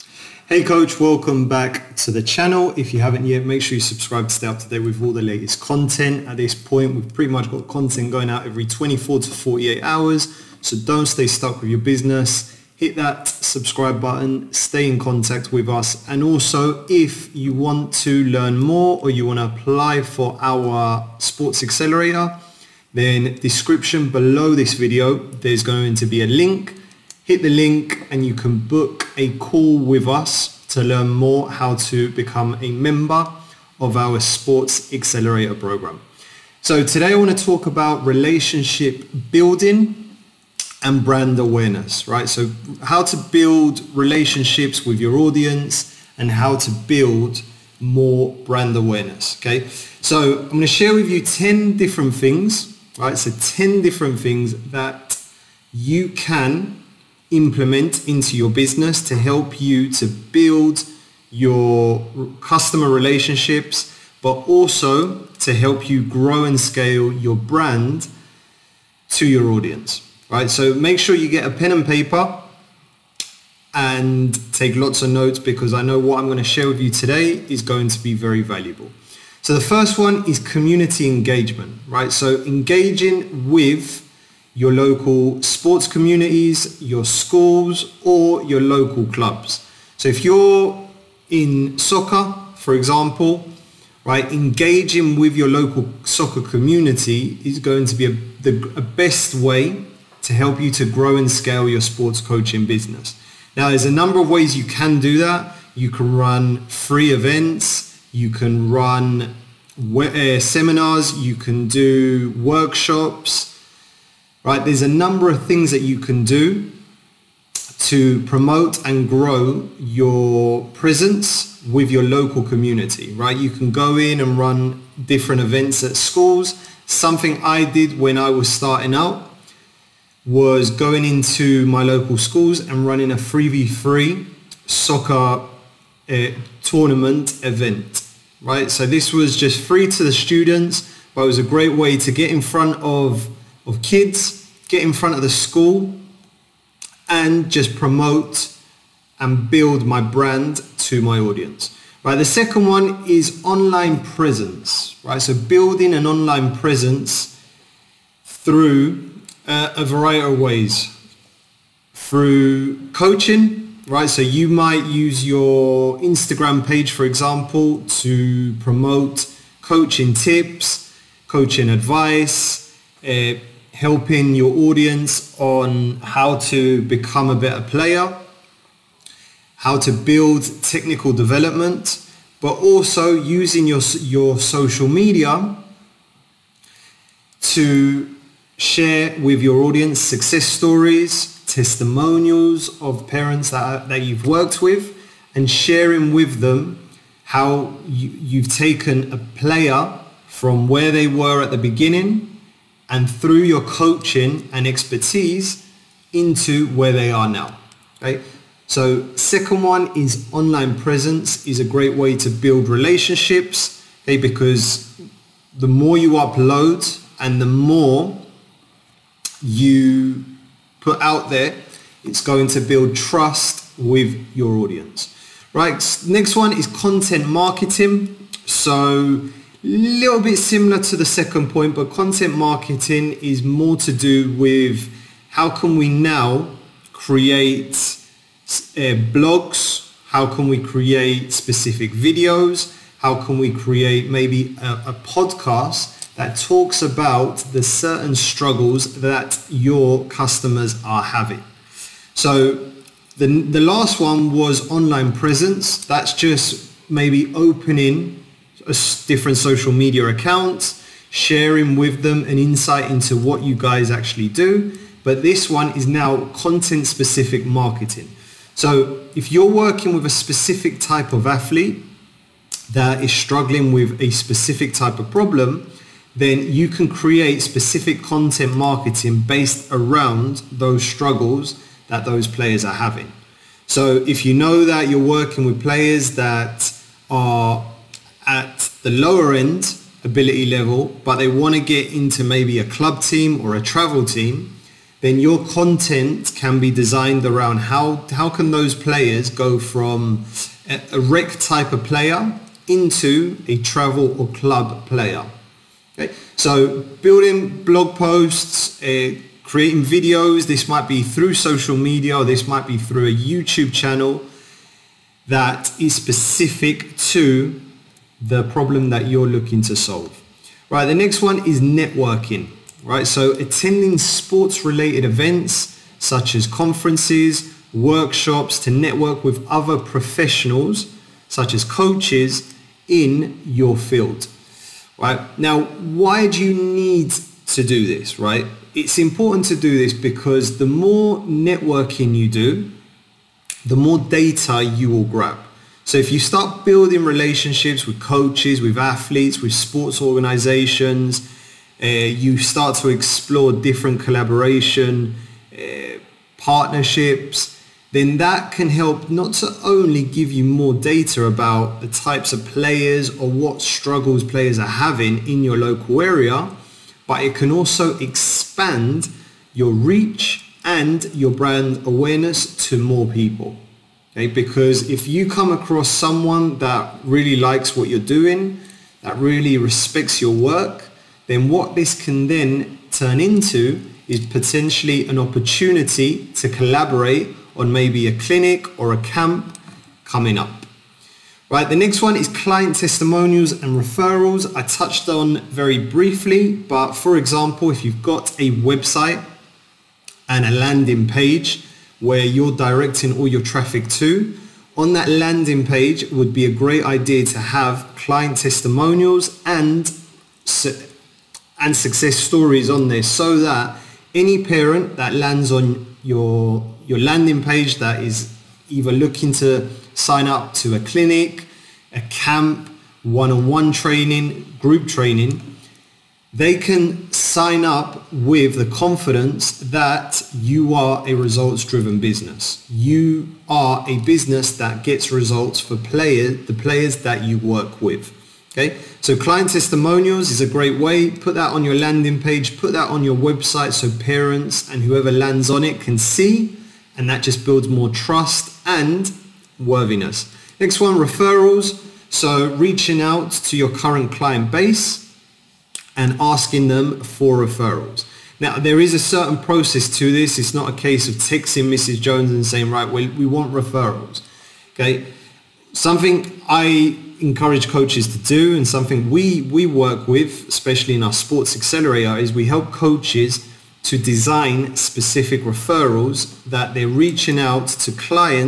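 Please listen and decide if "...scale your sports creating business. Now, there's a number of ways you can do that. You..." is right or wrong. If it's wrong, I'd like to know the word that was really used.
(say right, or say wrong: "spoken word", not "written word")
wrong: "coaching", not "creating".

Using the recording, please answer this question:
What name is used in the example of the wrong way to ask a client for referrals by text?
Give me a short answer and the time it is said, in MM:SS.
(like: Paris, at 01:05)
Mrs. Jones, at 07:41.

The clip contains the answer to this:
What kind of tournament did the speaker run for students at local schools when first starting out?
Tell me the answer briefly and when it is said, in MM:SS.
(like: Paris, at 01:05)
3v3 soccer tournament, at 02:13.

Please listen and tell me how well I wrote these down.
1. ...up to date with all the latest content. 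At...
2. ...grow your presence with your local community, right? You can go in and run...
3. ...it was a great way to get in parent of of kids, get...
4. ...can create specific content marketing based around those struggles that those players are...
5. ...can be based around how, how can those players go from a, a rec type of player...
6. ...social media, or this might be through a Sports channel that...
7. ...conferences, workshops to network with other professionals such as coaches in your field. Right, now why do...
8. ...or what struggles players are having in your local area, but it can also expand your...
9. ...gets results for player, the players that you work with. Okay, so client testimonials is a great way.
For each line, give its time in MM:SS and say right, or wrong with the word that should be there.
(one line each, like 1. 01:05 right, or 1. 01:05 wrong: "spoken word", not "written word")
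1. 00:04 right
2. 01:59 right
3. 02:21 wrong: "front", not "parent"
4. 04:36 right
5. 04:56 wrong: "designed", not "based"
6. 05:11 wrong: "YouTube", not "Sports"
7. 05:26 right
8. 06:03 right
9. 07:14 right.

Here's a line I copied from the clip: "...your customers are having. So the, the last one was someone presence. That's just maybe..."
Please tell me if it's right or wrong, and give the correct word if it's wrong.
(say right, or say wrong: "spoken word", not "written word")
wrong: "online", not "someone".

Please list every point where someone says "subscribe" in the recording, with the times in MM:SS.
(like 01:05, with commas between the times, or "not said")
00:03, 00:13.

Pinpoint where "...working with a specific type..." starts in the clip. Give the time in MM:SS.
04:29.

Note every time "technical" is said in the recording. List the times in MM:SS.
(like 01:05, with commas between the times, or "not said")
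03:00.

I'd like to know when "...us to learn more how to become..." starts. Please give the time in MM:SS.
00:30.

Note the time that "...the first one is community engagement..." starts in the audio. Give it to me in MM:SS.
01:19.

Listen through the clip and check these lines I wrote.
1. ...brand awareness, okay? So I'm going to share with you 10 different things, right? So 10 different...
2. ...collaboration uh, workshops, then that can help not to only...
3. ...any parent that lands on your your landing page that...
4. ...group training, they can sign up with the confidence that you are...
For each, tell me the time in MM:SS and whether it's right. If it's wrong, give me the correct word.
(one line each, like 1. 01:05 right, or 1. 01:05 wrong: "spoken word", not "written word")
1. 00:48 right
2. 05:53 wrong: "partnerships", not "workshops"
3. 06:54 right
4. 07:04 right.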